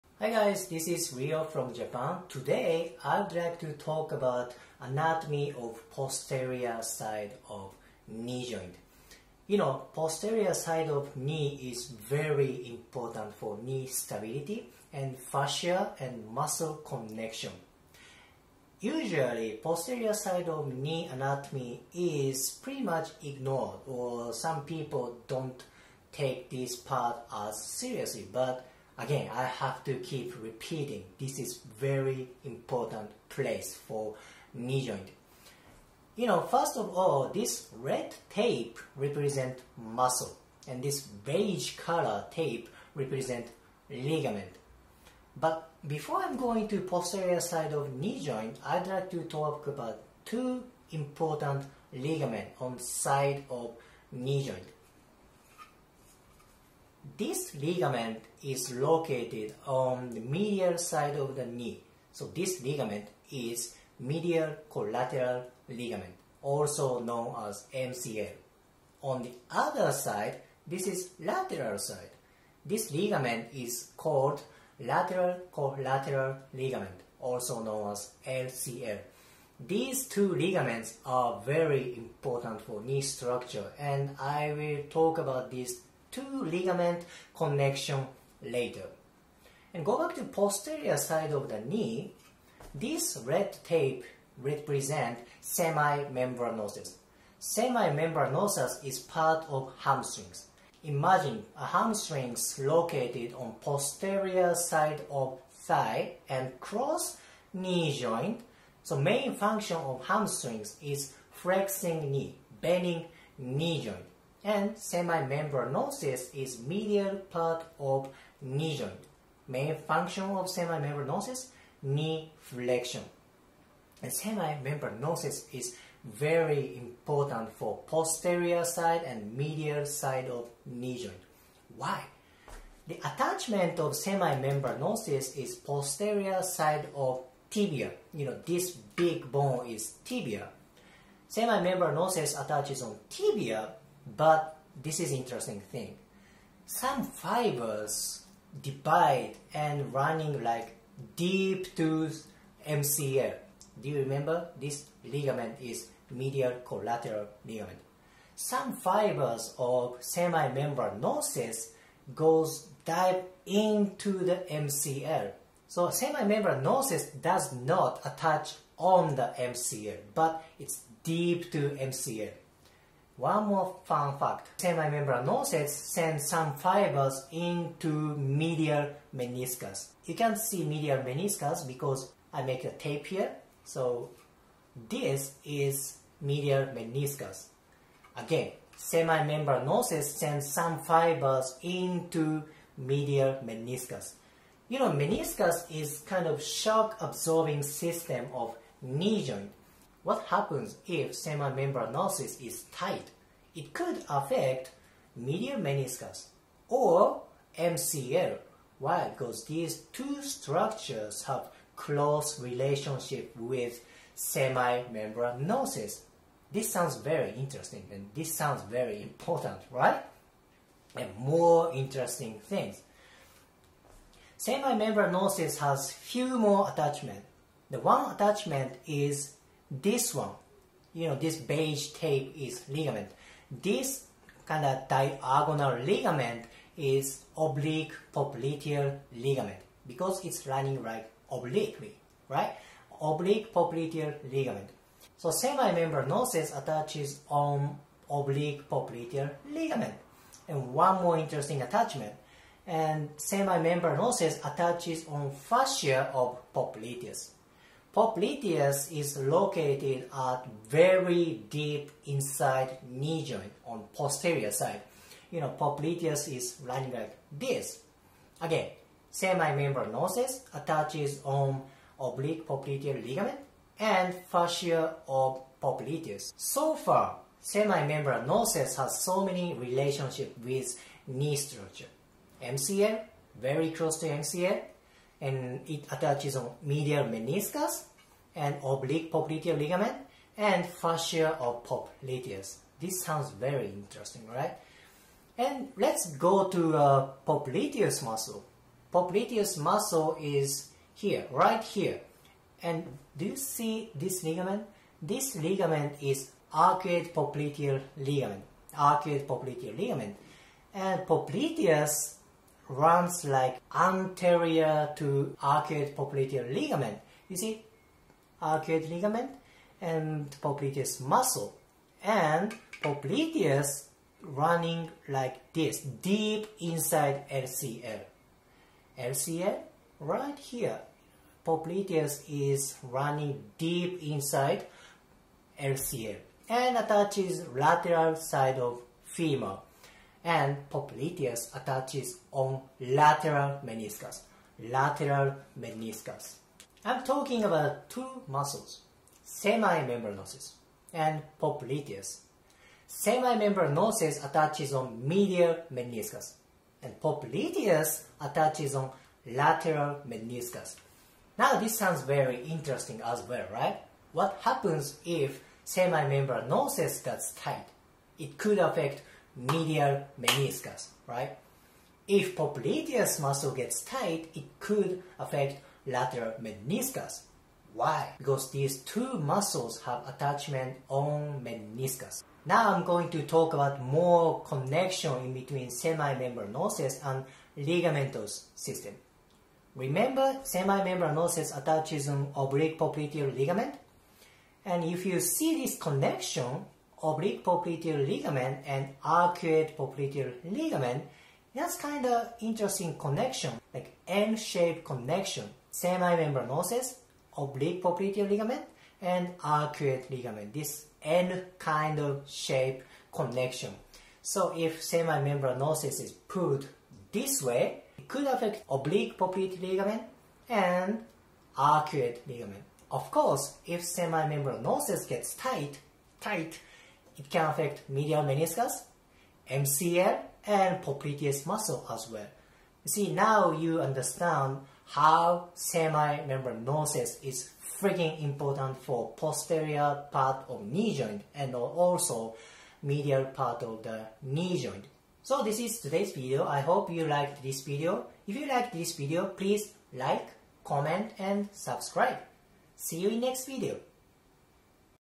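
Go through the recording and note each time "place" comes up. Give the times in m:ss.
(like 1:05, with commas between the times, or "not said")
0:33.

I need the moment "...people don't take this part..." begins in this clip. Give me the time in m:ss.
0:24.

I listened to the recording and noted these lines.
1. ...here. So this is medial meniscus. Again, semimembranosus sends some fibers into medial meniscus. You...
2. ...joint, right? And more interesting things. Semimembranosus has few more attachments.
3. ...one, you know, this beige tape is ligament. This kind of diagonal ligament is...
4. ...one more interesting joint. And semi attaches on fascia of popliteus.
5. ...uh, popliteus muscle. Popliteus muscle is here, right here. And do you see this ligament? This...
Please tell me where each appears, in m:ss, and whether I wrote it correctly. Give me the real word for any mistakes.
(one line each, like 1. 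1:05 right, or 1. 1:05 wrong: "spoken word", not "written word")
1. 3:03 right
2. 3:39 wrong: "important", not "joint"
3. 3:50 right
4. 4:10 wrong: "attachment", not "joint"
5. 4:56 right.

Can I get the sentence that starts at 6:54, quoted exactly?
So if semimembranosus is pulled this way, it could affect oblique popliteal ligament and arcuate ligament.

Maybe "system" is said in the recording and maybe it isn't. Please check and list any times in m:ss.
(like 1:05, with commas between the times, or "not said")
3:17, 6:28.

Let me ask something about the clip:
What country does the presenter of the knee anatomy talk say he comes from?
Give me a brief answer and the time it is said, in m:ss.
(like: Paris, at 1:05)
Japan, at 0:01.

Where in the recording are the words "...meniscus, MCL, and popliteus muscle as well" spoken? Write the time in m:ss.
7:08.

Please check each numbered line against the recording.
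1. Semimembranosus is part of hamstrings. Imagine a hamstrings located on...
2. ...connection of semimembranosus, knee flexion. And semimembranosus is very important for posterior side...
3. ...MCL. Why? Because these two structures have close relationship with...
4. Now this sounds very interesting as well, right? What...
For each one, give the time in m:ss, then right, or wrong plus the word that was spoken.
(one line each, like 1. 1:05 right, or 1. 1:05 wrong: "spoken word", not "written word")
1. 1:37 right
2. 1:59 wrong: "function", not "connection"
3. 3:27 right
4. 6:01 right.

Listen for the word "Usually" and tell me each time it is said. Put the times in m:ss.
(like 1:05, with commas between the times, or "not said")
0:18.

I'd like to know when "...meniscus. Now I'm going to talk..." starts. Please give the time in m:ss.
6:21.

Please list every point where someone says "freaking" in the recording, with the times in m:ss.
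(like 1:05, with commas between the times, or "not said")
7:17.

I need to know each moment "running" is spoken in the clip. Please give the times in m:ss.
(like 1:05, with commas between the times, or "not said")
2:29, 4:00, 4:26, 5:24, 5:32.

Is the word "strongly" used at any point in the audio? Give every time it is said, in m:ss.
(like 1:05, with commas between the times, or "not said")
not said.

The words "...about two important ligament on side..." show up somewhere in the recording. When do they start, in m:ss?
0:49.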